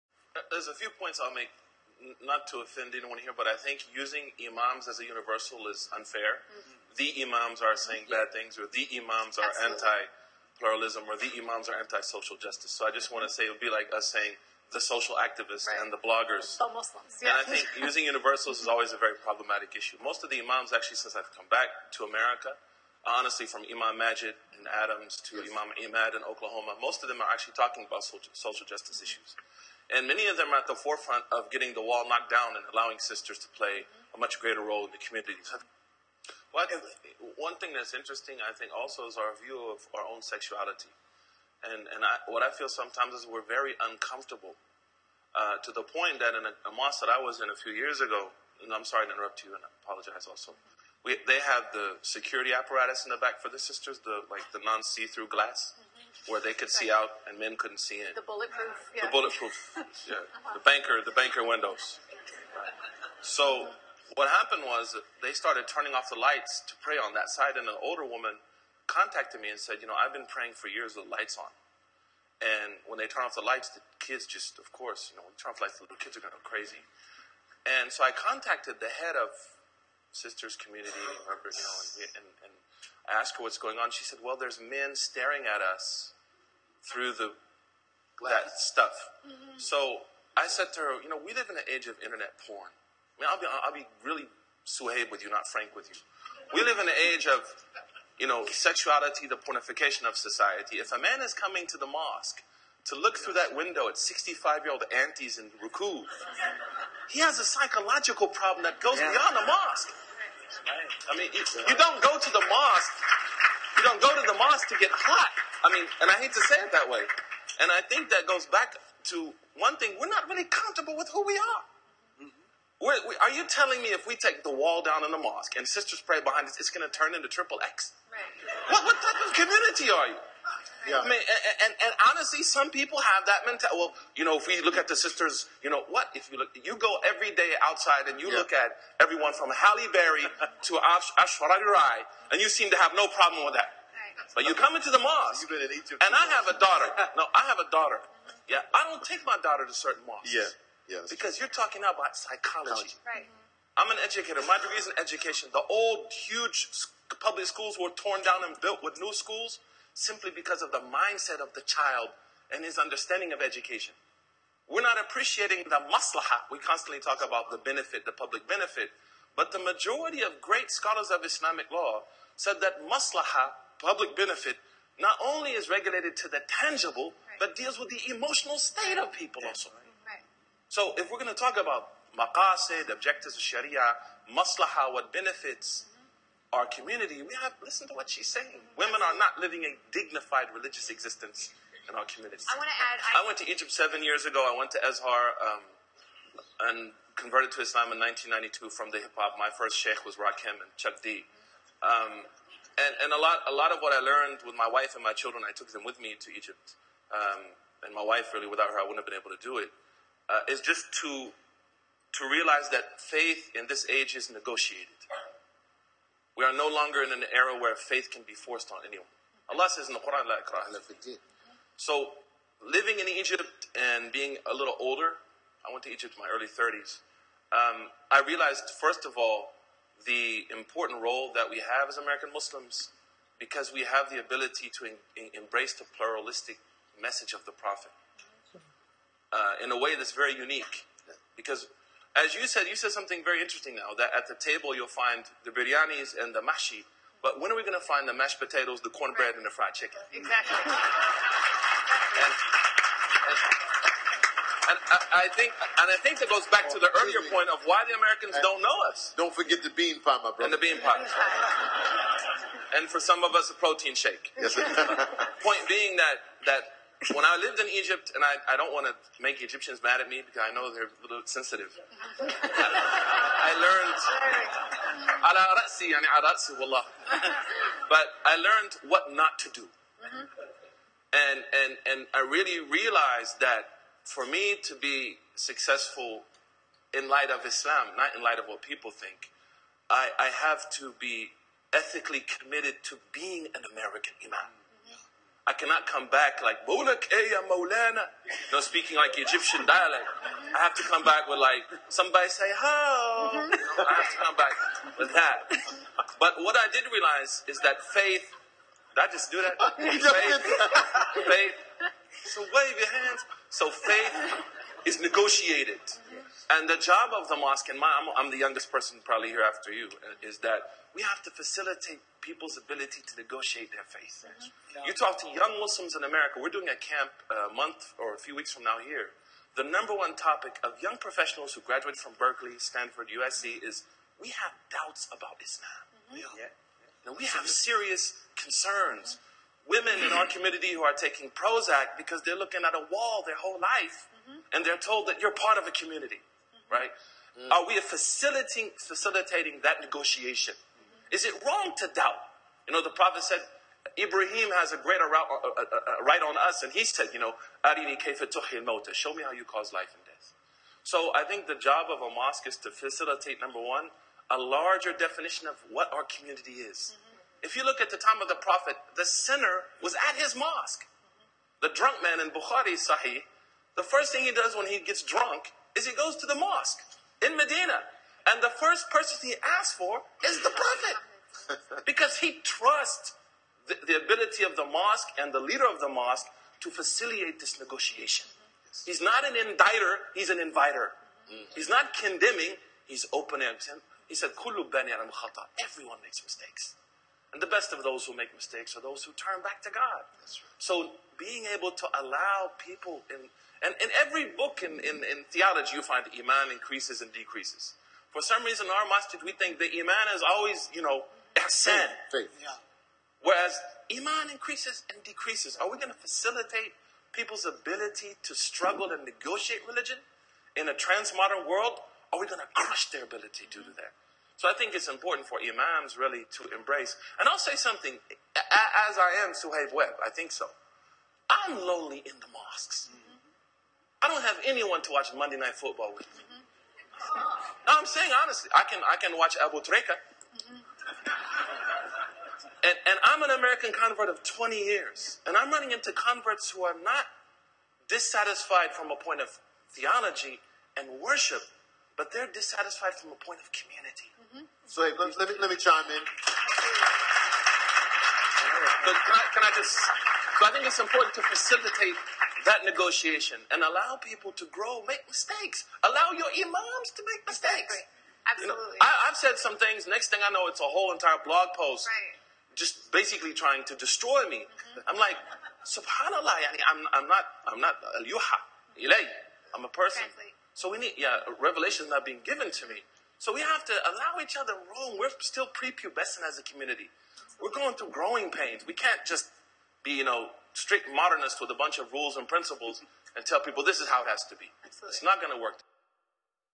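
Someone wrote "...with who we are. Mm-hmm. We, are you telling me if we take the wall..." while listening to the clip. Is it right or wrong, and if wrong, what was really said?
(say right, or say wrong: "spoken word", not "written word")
right.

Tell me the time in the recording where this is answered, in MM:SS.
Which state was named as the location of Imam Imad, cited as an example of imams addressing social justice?
00:26.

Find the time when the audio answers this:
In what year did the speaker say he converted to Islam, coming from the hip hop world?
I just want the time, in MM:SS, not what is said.
03:18.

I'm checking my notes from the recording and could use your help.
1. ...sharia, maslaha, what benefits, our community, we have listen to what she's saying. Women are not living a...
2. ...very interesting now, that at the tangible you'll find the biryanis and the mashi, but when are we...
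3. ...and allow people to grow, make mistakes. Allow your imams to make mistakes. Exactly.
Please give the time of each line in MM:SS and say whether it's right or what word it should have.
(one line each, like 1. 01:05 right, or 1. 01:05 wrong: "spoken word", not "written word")
1. 03:03 right
2. 04:03 wrong: "table", not "tangible"
3. 07:43 right.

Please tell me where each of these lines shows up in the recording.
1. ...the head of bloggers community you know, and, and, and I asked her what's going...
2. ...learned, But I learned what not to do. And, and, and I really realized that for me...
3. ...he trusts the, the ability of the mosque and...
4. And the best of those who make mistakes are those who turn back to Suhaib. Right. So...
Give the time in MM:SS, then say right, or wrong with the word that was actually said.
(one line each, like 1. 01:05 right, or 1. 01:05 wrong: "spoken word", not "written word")
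1. 01:18 wrong: "sisters", not "bloggers"
2. 04:33 right
3. 06:22 right
4. 06:37 wrong: "God", not "Suhaib".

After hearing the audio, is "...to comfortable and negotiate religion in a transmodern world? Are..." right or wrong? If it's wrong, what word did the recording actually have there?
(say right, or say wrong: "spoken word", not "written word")
wrong: "struggle", not "comfortable".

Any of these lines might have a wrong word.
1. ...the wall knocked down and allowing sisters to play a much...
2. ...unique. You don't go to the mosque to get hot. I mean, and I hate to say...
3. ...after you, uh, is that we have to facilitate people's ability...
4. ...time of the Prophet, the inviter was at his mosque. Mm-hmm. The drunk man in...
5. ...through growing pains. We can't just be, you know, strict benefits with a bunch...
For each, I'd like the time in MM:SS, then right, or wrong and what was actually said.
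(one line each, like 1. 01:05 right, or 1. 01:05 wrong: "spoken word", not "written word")
1. 00:31 right
2. 01:52 wrong: "mosque", not "unique"
3. 05:19 right
4. 06:07 wrong: "sinner", not "inviter"
5. 08:07 wrong: "modernists", not "benefits".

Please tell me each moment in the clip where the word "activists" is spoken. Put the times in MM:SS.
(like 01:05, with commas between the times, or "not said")
00:15.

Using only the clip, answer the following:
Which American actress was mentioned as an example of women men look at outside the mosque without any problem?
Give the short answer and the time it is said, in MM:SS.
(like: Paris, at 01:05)
Halle Berry, at 02:19.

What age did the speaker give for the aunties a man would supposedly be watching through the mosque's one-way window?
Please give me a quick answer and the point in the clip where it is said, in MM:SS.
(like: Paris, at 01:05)
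65, at 01:43.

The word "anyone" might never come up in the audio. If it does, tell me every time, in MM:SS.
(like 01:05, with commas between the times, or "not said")
00:02, 03:38, 07:14.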